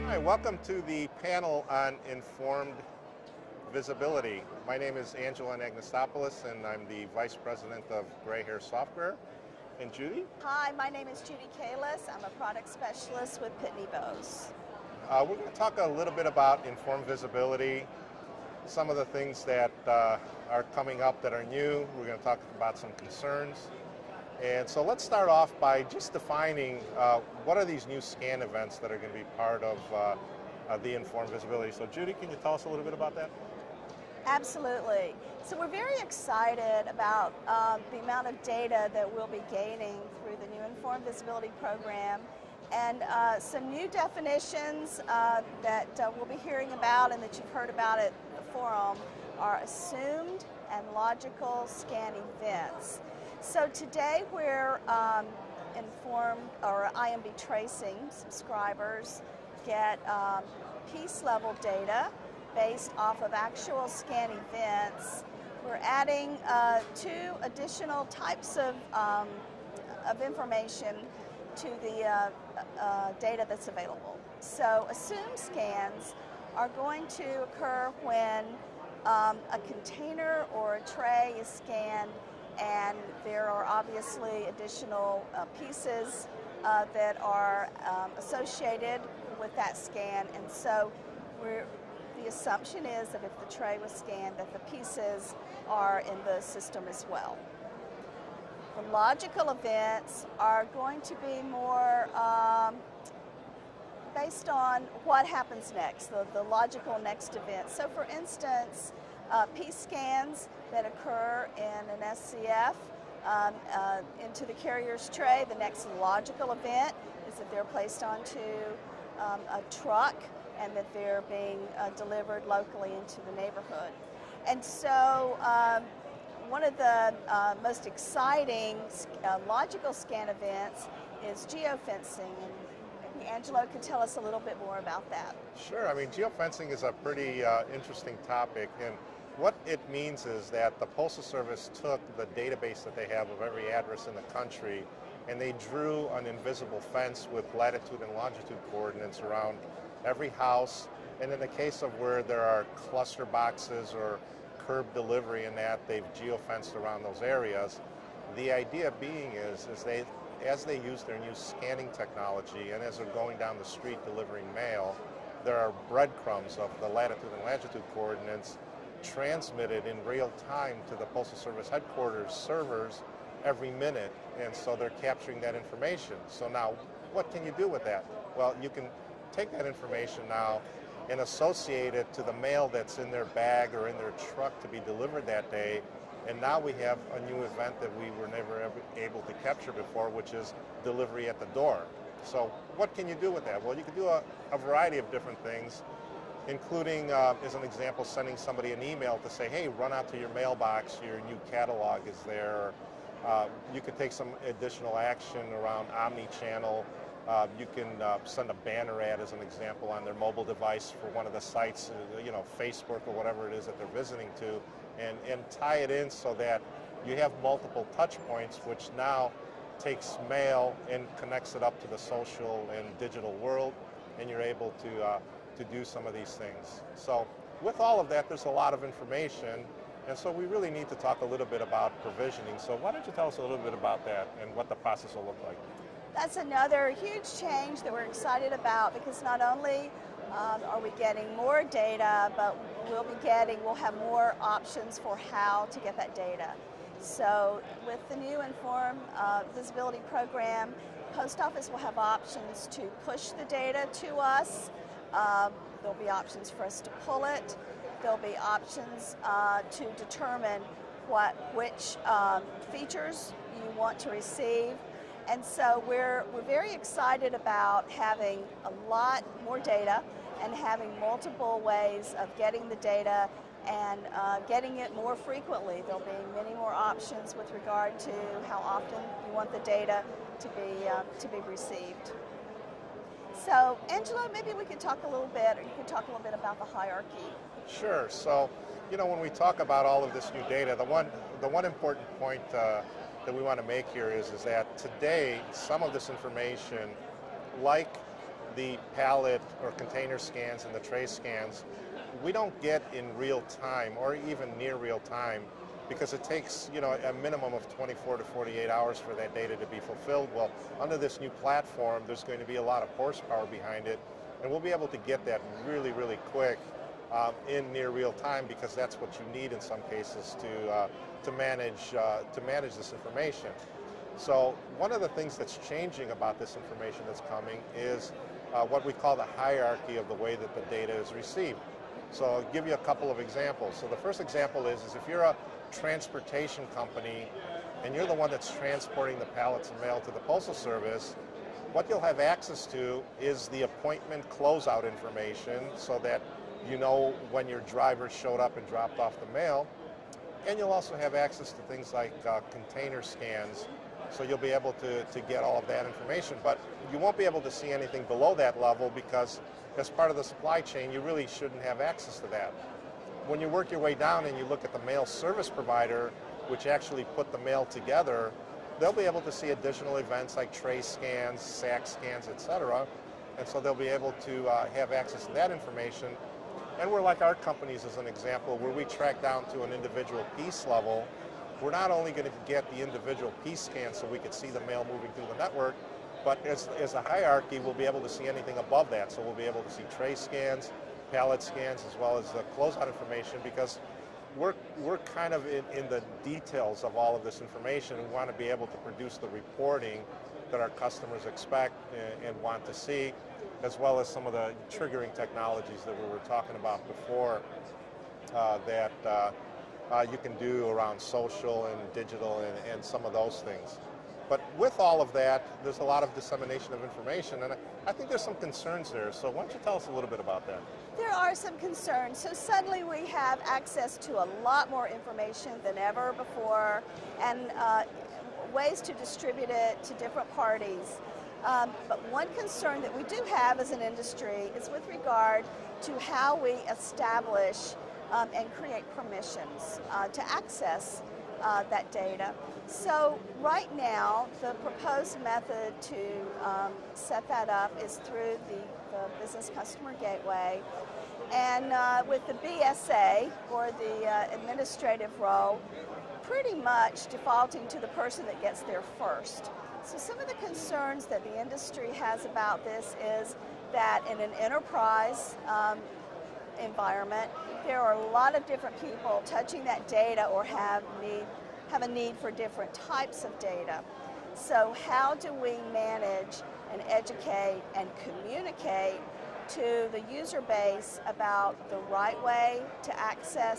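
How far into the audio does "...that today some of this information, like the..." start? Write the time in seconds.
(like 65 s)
294 s.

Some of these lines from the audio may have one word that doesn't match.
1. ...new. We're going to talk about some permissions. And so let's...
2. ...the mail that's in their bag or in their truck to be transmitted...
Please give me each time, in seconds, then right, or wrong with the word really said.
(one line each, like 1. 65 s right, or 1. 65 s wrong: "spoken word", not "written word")
1. 21 s wrong: "concerns", not "permissions"
2. 182 s wrong: "delivered", not "transmitted".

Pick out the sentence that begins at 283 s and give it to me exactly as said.
So Angelo, maybe we could talk a little bit, or you could talk a little bit about the hierarchy Sure.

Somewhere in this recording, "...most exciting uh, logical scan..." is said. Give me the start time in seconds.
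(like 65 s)
127 s.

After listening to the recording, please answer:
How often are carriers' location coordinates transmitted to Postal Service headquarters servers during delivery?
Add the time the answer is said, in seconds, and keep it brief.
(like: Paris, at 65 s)
Every minute, at 173 s.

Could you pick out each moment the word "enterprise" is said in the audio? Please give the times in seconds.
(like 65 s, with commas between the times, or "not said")
464 s.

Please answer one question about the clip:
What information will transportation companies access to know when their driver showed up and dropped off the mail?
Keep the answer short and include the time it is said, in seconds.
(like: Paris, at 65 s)
Appointment closeout information, at 343 s.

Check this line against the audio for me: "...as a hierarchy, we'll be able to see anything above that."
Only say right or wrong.
right.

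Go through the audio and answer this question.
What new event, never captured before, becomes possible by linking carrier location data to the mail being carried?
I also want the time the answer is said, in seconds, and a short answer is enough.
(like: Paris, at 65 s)
Delivery at the door, at 190 s.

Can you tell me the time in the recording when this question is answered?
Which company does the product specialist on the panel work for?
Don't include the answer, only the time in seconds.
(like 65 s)
13 s.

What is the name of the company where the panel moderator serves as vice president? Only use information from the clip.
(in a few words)
Gray Hair Software.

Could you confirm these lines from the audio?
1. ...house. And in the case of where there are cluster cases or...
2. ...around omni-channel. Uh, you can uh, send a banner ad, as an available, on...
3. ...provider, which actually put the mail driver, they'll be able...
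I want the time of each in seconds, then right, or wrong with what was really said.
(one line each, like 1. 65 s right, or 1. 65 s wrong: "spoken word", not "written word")
1. 150 s wrong: "boxes", not "cases"
2. 205 s wrong: "example", not "available"
3. 365 s wrong: "together", not "driver".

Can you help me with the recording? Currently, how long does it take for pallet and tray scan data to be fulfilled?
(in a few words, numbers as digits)
24 to 48 hours.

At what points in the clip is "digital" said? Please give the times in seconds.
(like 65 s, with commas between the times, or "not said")
222 s, 411 s.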